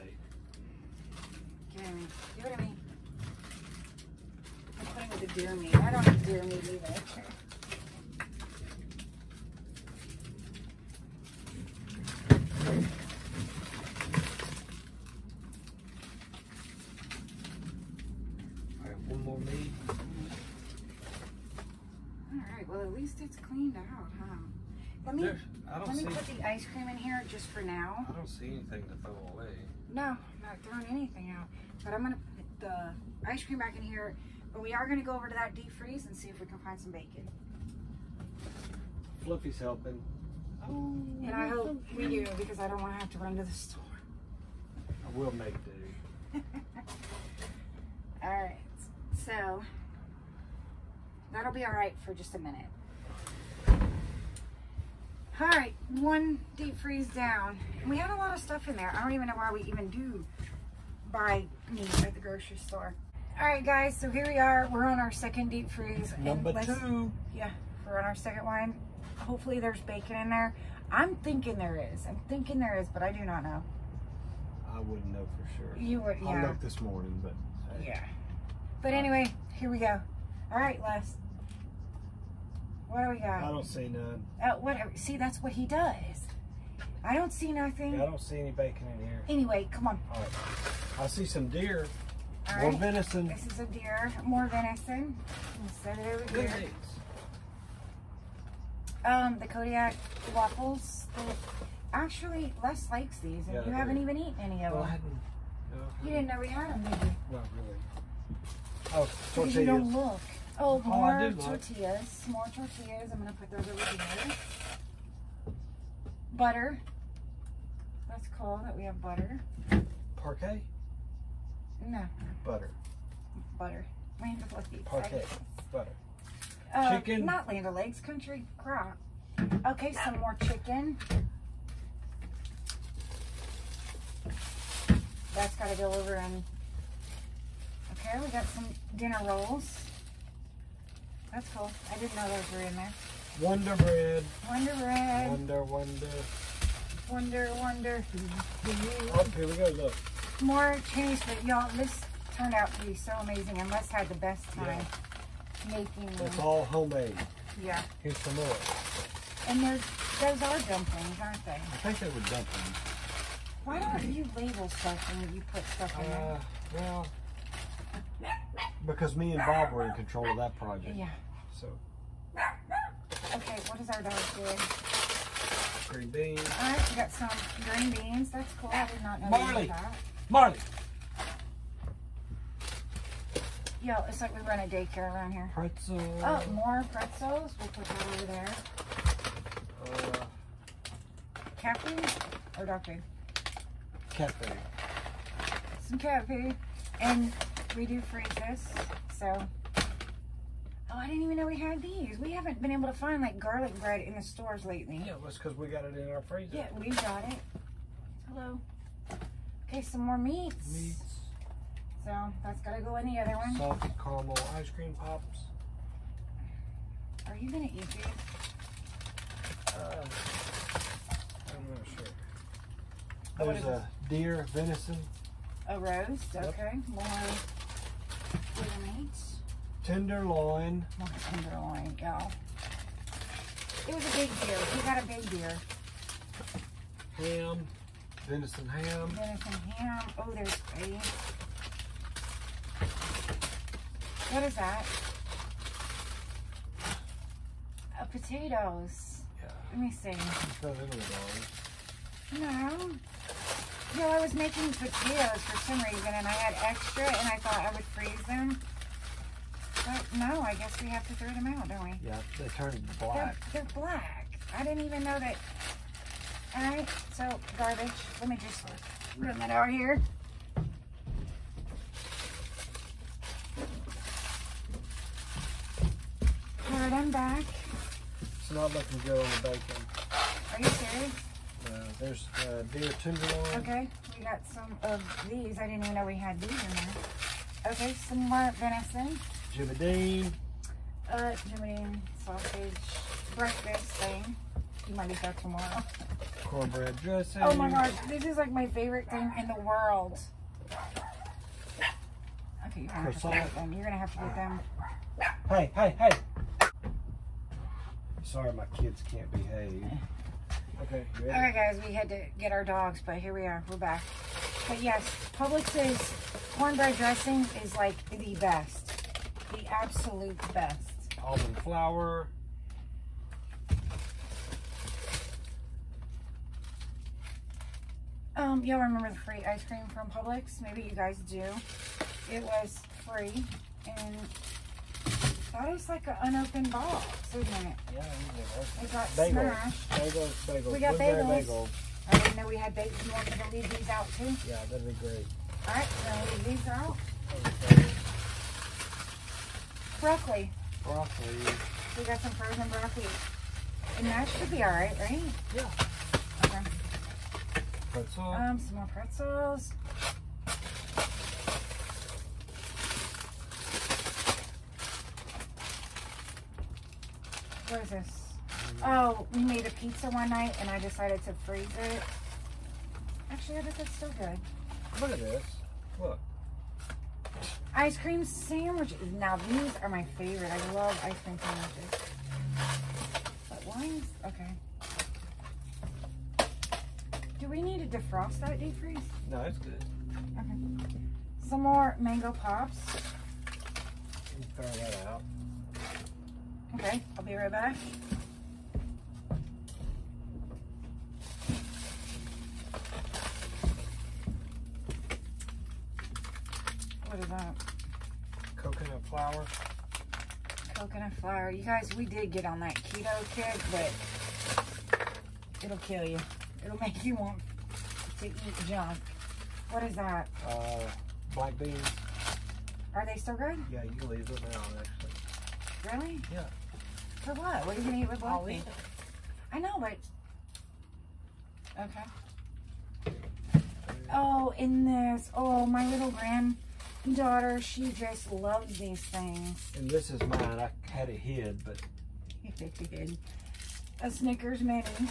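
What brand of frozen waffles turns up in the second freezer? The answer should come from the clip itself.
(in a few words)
Kodiak.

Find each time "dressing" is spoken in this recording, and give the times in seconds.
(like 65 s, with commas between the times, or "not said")
296 s, 316 s.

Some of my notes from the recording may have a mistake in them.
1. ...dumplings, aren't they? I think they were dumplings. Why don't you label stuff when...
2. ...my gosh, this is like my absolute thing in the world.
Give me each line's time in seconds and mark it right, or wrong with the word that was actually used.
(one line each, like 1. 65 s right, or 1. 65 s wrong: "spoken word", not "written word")
1. 160 s right
2. 297 s wrong: "favorite", not "absolute".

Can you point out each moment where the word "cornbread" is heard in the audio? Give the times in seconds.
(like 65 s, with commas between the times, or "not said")
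296 s, 316 s.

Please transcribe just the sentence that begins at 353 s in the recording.
And that should be all right, right?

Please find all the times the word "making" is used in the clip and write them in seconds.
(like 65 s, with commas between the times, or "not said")
155 s, 254 s.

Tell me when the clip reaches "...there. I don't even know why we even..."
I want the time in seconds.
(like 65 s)
58 s.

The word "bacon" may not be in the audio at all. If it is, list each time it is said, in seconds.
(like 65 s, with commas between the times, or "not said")
36 s, 69 s, 88 s, 279 s.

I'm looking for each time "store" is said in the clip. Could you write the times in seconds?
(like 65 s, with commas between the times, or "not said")
43 s, 62 s, 204 s.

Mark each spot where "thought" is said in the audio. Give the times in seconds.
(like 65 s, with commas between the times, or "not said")
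257 s.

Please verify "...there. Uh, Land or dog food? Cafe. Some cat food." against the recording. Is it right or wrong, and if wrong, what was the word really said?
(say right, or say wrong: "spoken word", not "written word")
wrong: "Cafe", not "Land".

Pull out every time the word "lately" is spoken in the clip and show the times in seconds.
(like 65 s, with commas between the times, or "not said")
204 s.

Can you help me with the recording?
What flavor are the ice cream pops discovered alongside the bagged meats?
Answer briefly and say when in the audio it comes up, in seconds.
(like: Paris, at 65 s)
Salted caramel, at 213 s.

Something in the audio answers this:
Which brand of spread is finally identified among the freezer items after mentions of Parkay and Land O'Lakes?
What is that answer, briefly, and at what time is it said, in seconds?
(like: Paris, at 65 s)
Country Crock, at 127 s.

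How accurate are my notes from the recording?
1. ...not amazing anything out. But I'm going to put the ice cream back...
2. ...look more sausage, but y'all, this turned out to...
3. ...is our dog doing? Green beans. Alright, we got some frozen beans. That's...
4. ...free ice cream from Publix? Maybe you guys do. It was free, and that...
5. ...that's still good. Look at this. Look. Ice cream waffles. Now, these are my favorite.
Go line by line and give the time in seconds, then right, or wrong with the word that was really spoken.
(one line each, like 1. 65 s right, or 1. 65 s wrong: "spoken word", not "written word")
1. 30 s wrong: "throwing", not "amazing"
2. 149 s wrong: "change", not "sausage"
3. 173 s wrong: "green", not "frozen"
4. 329 s right
5. 373 s wrong: "sandwiches", not "waffles".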